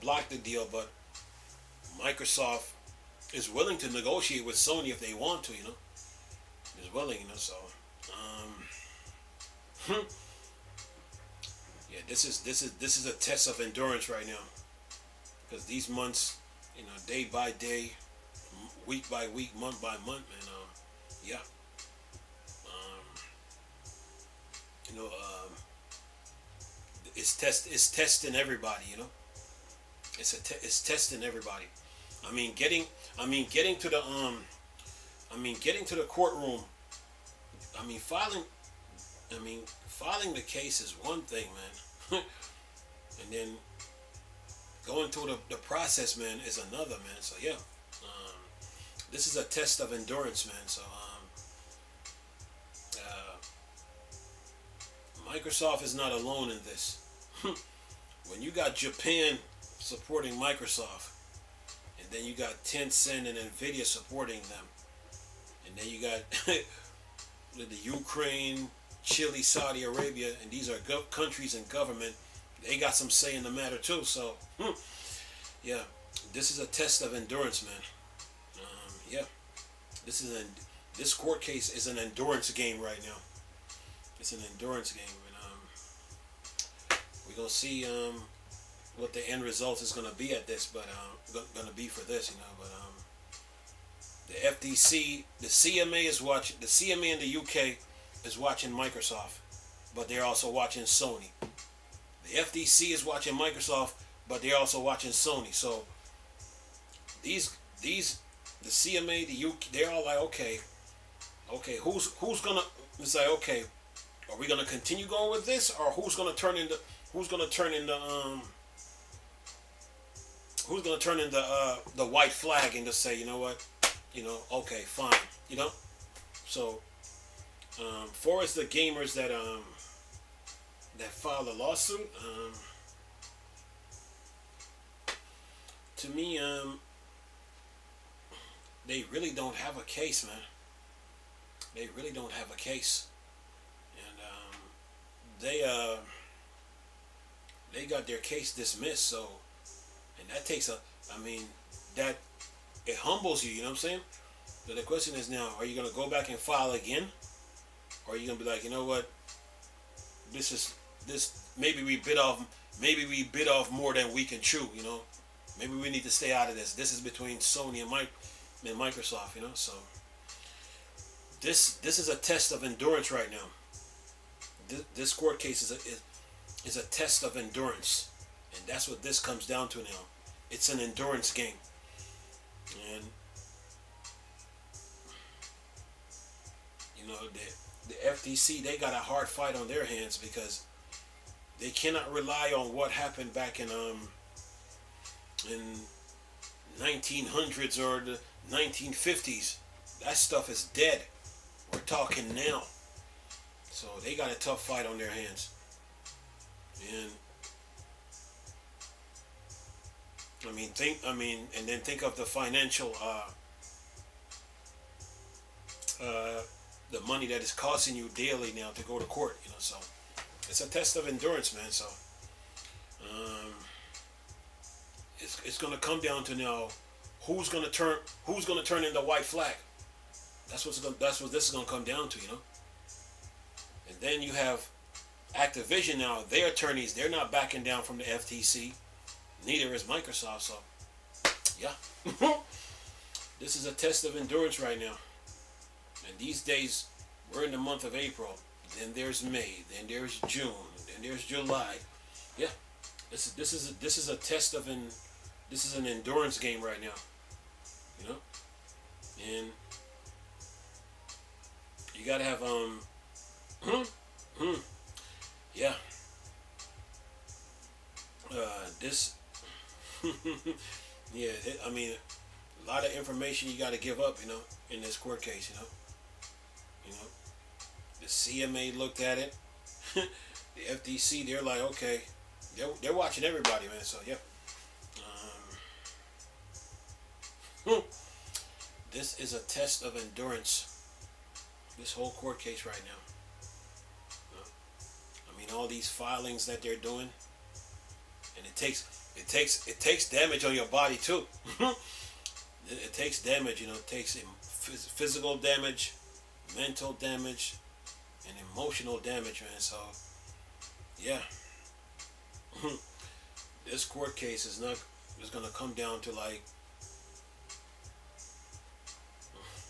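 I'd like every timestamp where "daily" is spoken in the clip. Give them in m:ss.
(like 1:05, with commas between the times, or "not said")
3:38.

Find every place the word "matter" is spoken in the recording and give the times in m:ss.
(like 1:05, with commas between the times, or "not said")
1:13.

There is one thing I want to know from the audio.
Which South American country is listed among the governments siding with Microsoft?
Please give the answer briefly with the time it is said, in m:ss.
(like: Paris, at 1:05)
Chile, at 1:09.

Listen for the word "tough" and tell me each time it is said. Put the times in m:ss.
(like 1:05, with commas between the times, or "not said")
3:24.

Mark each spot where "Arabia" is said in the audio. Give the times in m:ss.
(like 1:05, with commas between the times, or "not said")
1:09.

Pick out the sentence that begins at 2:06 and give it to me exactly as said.
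So, um, for the gamers that um that filed a lawsuit, um, to me, um, they really don't have a case, man.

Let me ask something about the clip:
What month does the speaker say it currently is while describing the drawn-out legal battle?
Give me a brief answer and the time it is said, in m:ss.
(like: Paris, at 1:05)
April, at 4:07.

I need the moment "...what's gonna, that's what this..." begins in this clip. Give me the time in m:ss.
3:50.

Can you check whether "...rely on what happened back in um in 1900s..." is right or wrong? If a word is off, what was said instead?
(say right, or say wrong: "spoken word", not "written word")
right.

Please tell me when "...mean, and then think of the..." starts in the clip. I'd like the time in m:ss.
3:31.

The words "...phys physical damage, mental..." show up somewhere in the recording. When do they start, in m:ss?
5:04.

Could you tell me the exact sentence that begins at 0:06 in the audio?
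Is willing, you know, so um hmm.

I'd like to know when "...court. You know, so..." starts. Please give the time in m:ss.
3:39.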